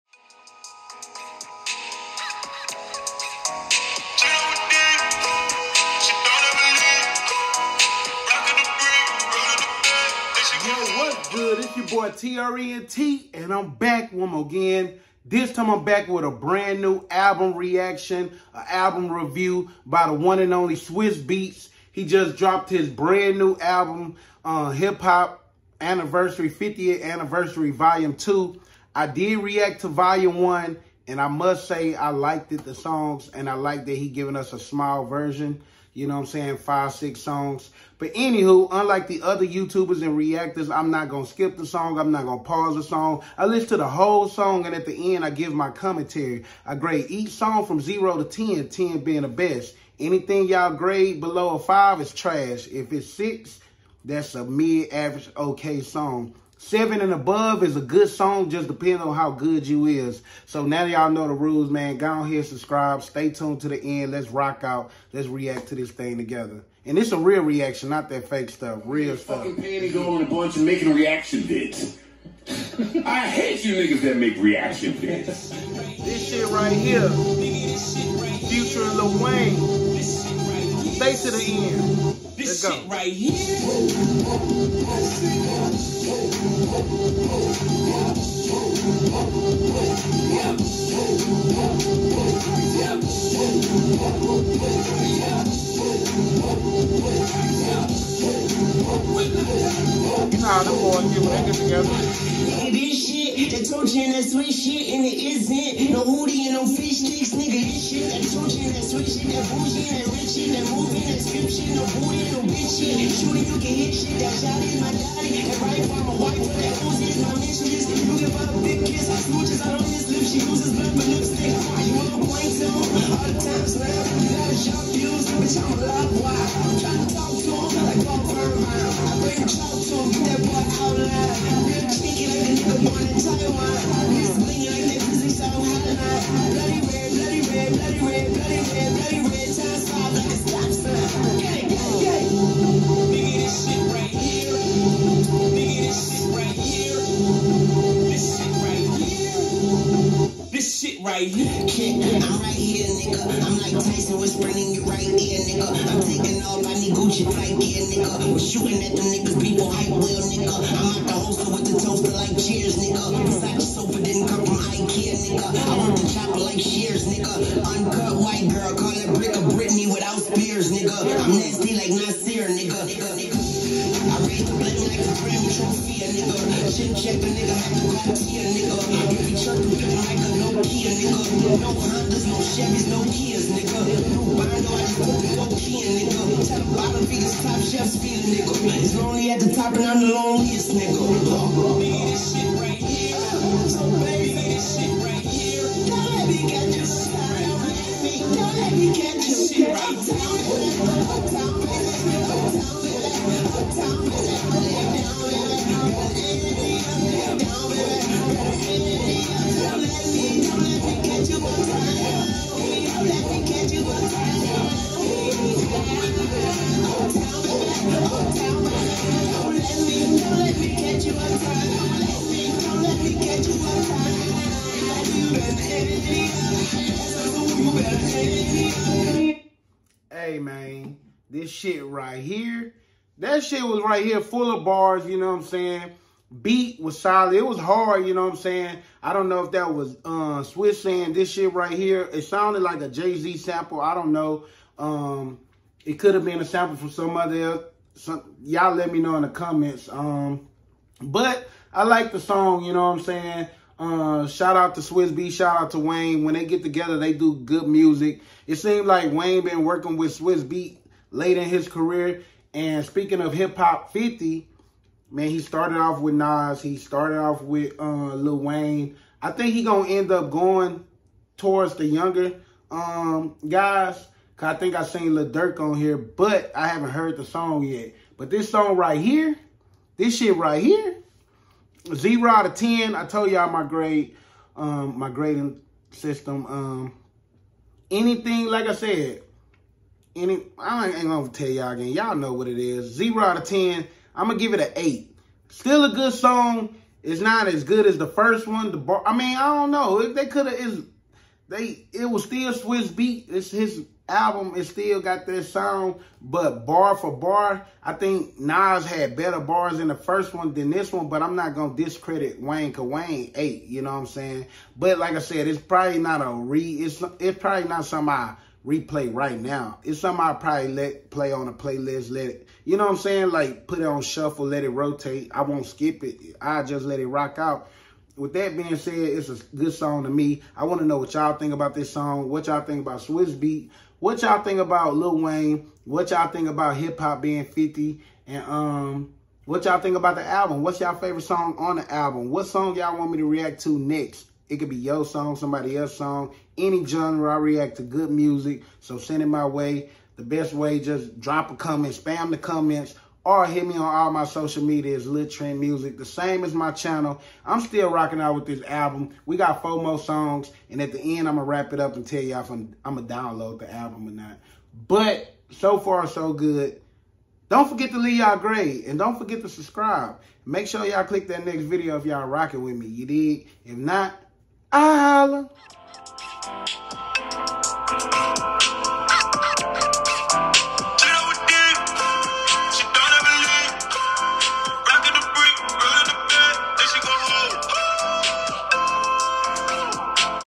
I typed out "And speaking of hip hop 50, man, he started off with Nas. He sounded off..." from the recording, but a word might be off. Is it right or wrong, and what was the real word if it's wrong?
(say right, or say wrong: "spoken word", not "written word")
wrong: "started", not "sounded".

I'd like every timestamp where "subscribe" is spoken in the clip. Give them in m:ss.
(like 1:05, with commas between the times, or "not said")
1:02, 6:09.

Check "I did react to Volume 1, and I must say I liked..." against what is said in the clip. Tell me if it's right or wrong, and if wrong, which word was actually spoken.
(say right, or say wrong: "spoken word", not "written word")
right.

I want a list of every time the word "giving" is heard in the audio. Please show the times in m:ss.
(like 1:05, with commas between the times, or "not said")
0:34.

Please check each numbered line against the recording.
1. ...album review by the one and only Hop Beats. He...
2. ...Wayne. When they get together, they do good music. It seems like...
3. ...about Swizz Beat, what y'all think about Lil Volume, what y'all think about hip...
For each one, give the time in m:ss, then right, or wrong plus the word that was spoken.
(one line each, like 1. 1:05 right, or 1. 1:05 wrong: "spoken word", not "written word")
1. 0:18 wrong: "Swizz", not "Hop"
2. 4:15 right
3. 5:32 wrong: "Wayne", not "Volume".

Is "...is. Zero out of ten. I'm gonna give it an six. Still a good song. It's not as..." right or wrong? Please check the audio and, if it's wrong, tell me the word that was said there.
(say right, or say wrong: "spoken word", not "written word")
wrong: "eight", not "six".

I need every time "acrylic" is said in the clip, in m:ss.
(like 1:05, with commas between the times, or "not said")
not said.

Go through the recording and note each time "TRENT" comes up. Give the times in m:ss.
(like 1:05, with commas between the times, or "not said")
0:12, 5:55.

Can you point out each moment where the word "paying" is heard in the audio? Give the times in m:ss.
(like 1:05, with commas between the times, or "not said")
1:09.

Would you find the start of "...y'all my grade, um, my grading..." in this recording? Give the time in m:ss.
4:43.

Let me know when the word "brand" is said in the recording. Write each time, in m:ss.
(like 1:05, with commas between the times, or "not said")
0:16, 0:22.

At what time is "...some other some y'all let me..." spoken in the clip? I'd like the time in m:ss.
4:06.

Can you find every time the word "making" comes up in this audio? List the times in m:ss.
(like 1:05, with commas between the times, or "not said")
1:10.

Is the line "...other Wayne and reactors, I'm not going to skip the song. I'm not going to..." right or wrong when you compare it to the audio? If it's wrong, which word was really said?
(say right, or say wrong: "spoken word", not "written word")
wrong: "YouTubers", not "Wayne".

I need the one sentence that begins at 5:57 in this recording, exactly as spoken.
I'm still rocking out with this album.